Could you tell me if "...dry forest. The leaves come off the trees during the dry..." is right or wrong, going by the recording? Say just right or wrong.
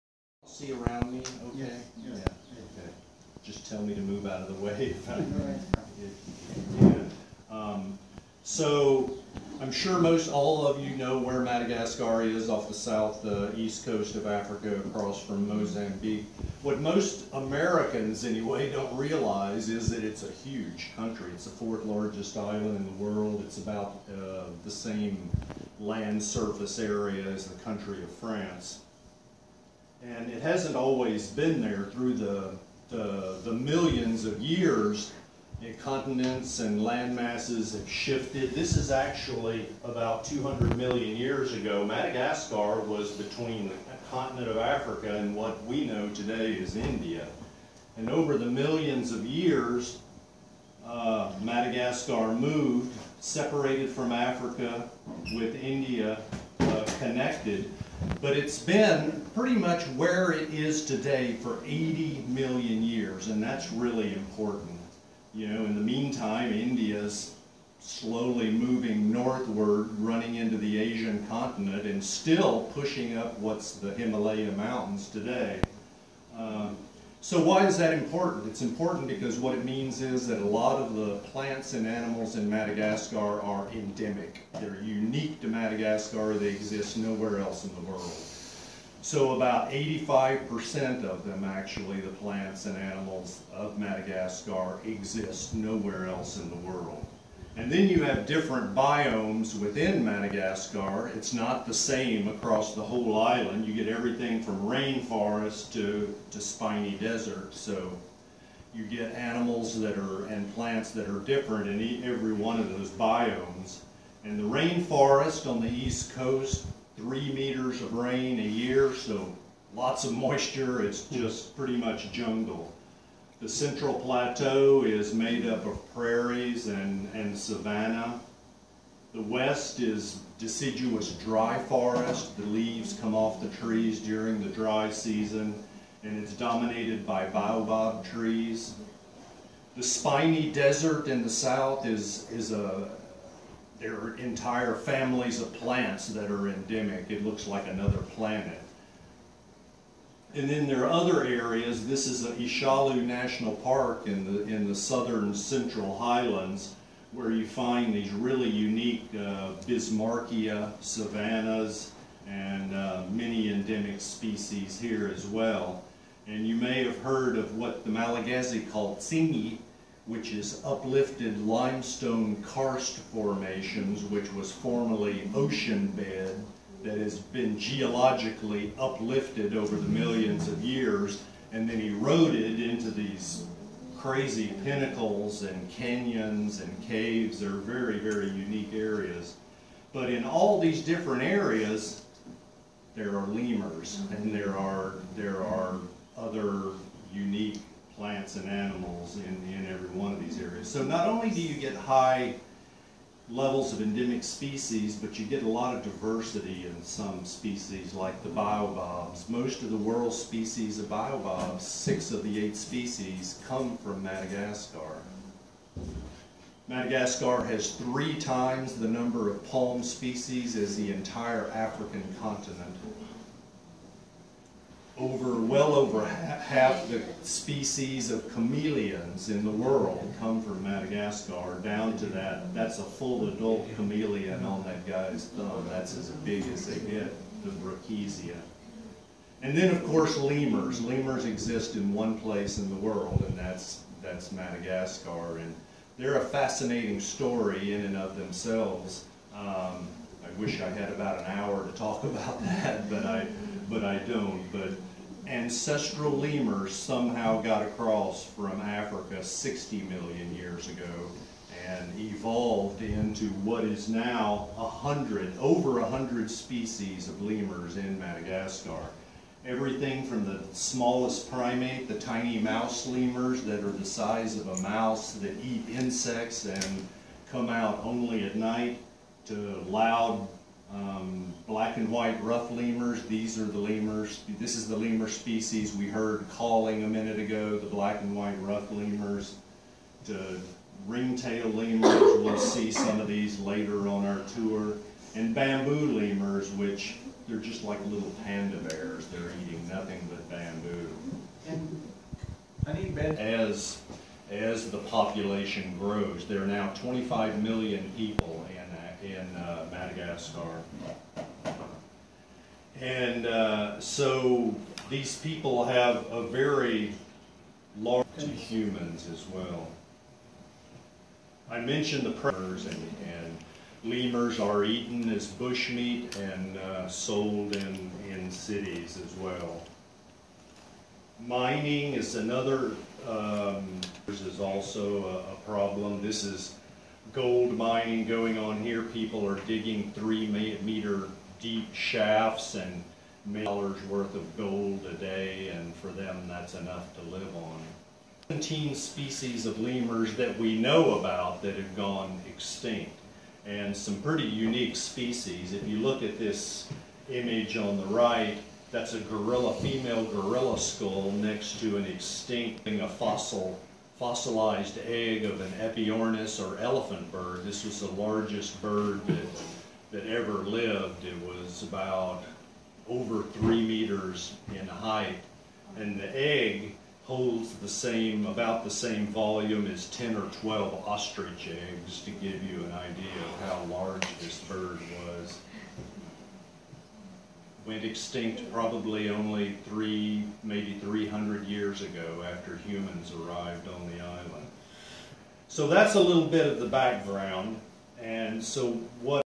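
right.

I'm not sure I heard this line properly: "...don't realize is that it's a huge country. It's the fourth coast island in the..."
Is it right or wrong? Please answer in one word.
wrong.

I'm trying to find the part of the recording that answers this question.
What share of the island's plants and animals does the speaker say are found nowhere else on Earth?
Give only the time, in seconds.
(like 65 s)
89 s.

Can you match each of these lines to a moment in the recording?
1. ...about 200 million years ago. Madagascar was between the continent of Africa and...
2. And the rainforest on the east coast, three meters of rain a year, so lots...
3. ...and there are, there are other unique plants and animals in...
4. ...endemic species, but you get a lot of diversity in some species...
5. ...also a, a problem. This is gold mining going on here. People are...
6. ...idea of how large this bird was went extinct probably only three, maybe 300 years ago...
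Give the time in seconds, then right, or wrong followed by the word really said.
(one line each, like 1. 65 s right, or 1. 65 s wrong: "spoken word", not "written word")
1. 39 s right
2. 114 s right
3. 194 s right
4. 203 s right
5. 334 s right
6. 382 s right.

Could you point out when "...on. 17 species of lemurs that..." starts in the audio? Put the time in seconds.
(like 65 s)
347 s.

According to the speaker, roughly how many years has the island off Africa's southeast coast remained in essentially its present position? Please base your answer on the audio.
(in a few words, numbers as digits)
80 million years.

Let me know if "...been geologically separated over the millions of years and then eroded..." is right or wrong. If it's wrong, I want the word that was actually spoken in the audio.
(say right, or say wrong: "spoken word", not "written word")
wrong: "uplifted", not "separated".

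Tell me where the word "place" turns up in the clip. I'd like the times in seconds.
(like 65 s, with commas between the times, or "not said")
242 s.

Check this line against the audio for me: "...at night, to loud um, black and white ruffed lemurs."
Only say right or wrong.
right.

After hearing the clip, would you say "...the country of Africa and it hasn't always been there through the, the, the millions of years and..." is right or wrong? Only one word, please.
wrong.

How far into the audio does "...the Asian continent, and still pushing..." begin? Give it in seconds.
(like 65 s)
70 s.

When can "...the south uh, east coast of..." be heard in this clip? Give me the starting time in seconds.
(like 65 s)
12 s.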